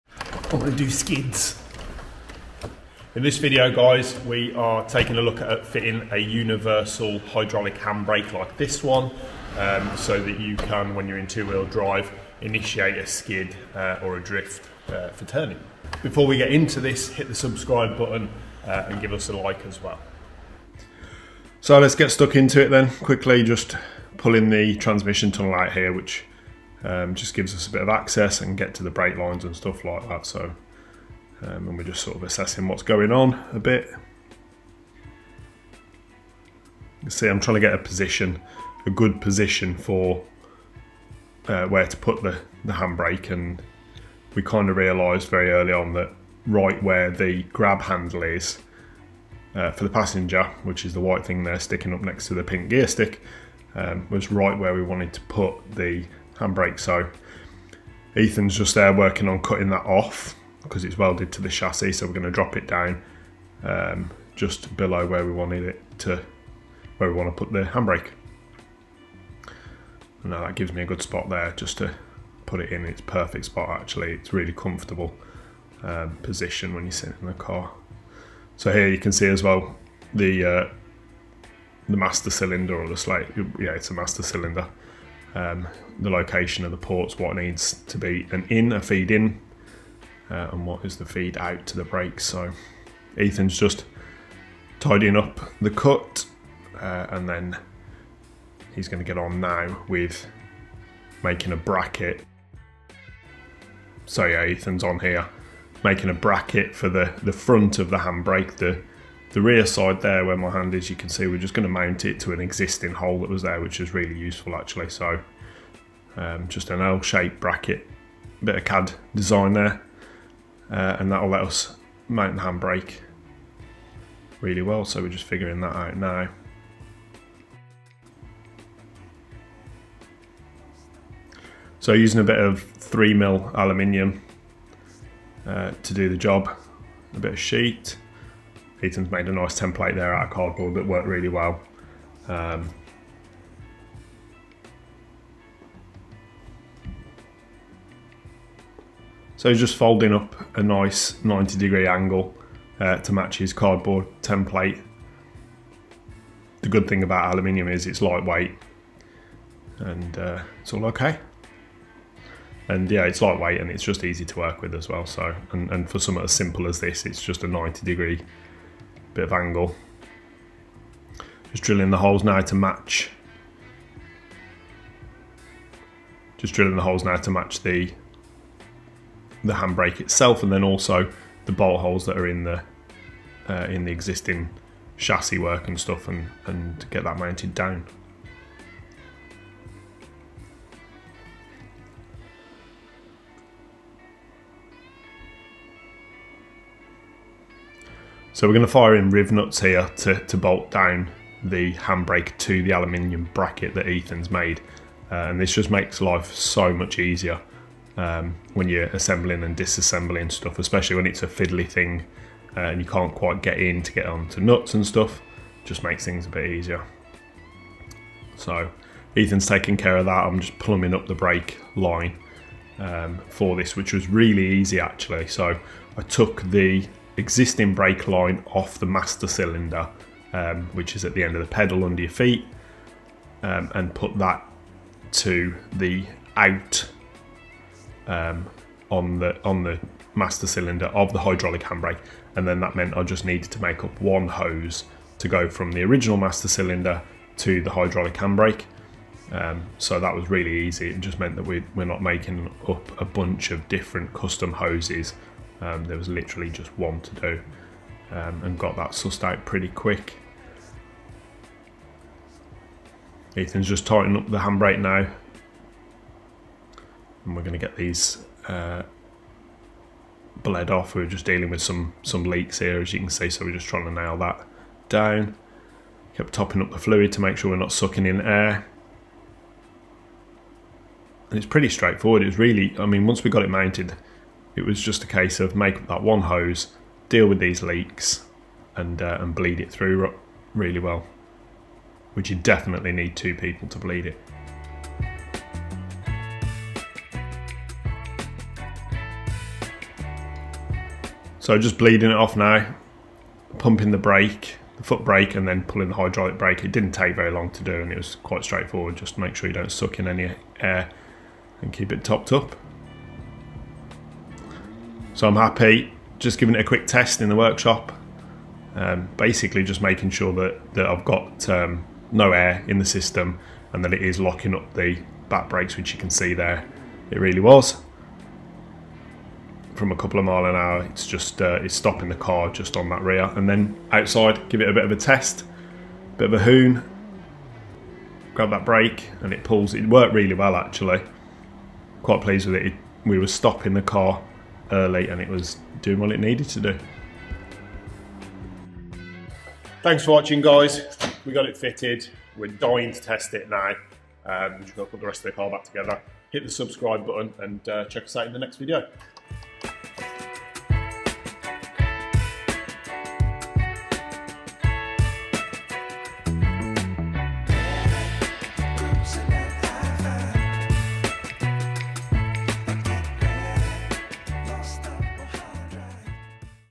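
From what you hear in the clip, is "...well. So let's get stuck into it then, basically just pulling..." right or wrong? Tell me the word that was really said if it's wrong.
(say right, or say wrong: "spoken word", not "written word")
wrong: "quickly", not "basically".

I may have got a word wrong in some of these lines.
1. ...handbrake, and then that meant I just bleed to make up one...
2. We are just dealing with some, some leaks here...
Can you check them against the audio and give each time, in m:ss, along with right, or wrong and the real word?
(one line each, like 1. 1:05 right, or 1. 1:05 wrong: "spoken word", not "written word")
1. 4:01 wrong: "needed", not "bleed"
2. 4:30 right.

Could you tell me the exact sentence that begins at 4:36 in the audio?
Kept topping up the fluid to make sure we're not sucking in air.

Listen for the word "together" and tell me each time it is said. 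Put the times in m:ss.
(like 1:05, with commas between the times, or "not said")
5:55.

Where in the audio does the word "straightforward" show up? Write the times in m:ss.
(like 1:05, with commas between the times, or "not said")
4:41, 5:08.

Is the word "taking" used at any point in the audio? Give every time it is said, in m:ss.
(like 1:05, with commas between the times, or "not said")
0:04, 3:39.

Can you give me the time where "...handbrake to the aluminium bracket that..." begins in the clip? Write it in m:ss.
3:21.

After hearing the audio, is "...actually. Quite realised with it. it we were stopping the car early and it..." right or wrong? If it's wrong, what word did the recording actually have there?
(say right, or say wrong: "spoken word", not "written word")
wrong: "pleased", not "realised".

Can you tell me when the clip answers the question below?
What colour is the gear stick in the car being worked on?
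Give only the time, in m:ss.
0:52.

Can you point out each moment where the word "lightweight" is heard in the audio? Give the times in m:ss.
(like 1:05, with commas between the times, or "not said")
2:38, 2:43.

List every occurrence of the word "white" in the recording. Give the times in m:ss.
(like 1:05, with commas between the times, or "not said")
0:51.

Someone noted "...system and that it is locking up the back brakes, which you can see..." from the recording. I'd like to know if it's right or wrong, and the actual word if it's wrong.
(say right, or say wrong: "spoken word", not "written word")
right.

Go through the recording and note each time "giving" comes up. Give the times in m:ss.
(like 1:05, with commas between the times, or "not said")
5:16.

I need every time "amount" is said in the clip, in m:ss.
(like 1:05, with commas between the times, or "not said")
not said.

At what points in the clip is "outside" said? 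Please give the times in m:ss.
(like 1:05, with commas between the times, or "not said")
5:33.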